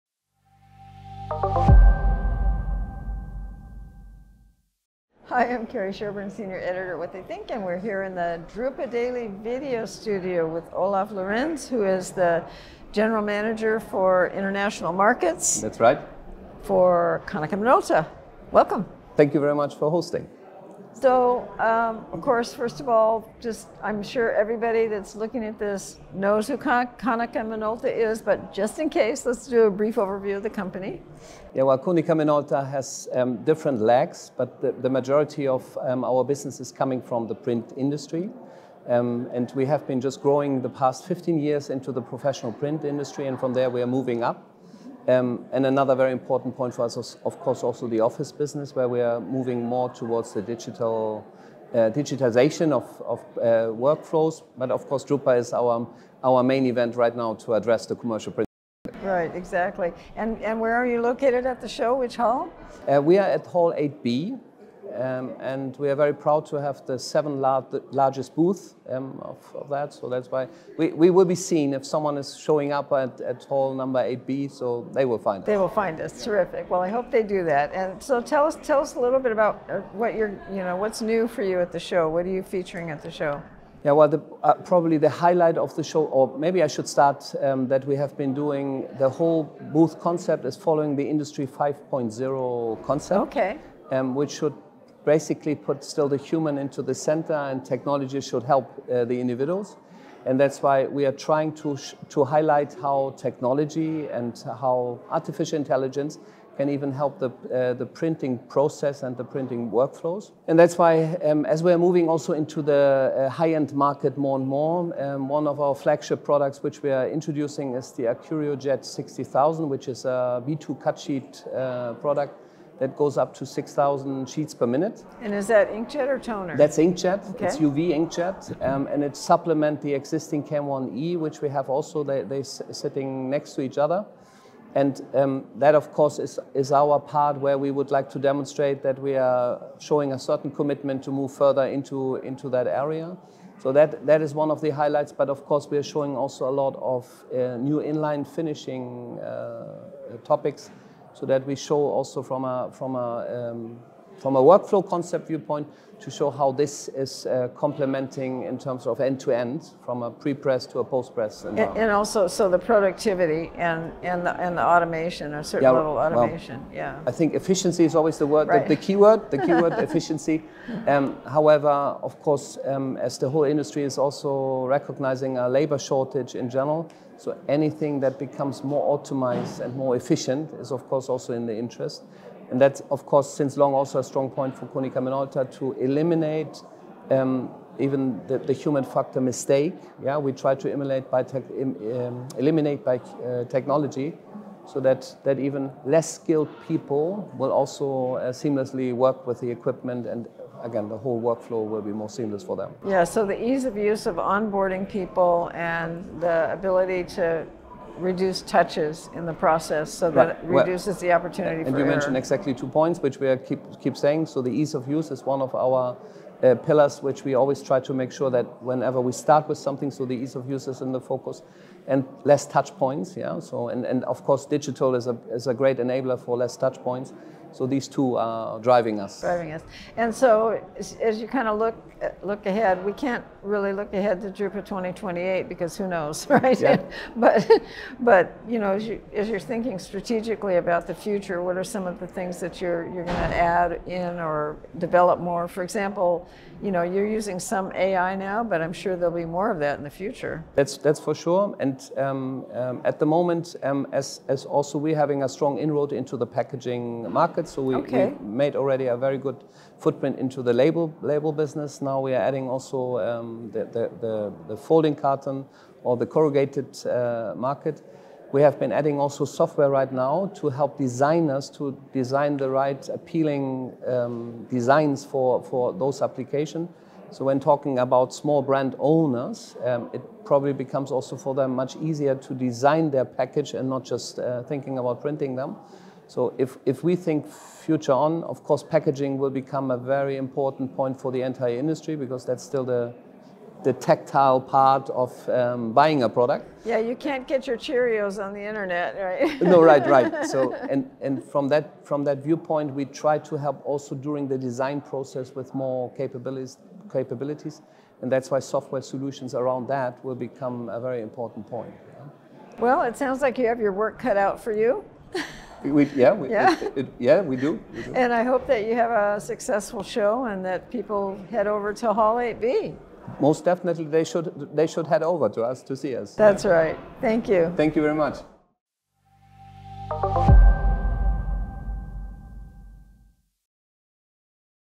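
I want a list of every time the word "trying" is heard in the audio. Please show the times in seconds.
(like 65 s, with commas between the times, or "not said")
101 s.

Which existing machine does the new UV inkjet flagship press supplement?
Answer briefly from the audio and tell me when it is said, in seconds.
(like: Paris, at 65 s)
KM-1e, at 130 s.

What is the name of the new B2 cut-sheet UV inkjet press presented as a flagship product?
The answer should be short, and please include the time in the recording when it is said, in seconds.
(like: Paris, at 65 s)
AccurioJet 60,000, at 118 s.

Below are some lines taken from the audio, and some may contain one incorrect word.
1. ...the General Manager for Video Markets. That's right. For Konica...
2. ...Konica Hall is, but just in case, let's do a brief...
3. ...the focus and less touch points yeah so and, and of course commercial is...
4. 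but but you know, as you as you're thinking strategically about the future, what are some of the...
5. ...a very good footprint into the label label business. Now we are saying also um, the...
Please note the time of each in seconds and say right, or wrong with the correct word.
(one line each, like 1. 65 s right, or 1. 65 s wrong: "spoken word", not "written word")
1. 12 s wrong: "International", not "Video"
2. 26 s wrong: "Minolta", not "Hall"
3. 220 s wrong: "digital", not "commercial"
4. 237 s right
5. 258 s wrong: "adding", not "saying".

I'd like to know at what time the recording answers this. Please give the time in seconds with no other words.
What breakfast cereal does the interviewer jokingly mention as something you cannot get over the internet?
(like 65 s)
297 s.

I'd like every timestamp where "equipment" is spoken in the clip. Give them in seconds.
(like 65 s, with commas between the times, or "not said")
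199 s.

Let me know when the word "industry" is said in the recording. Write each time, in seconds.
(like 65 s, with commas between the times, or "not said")
37 s, 42 s, 91 s, 173 s, 291 s.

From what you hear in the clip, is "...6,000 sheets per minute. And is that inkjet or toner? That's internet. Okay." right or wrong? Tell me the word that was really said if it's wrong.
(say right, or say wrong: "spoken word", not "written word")
wrong: "inkjet", not "internet".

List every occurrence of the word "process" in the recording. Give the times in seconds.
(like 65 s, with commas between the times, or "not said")
108 s, 209 s, 304 s.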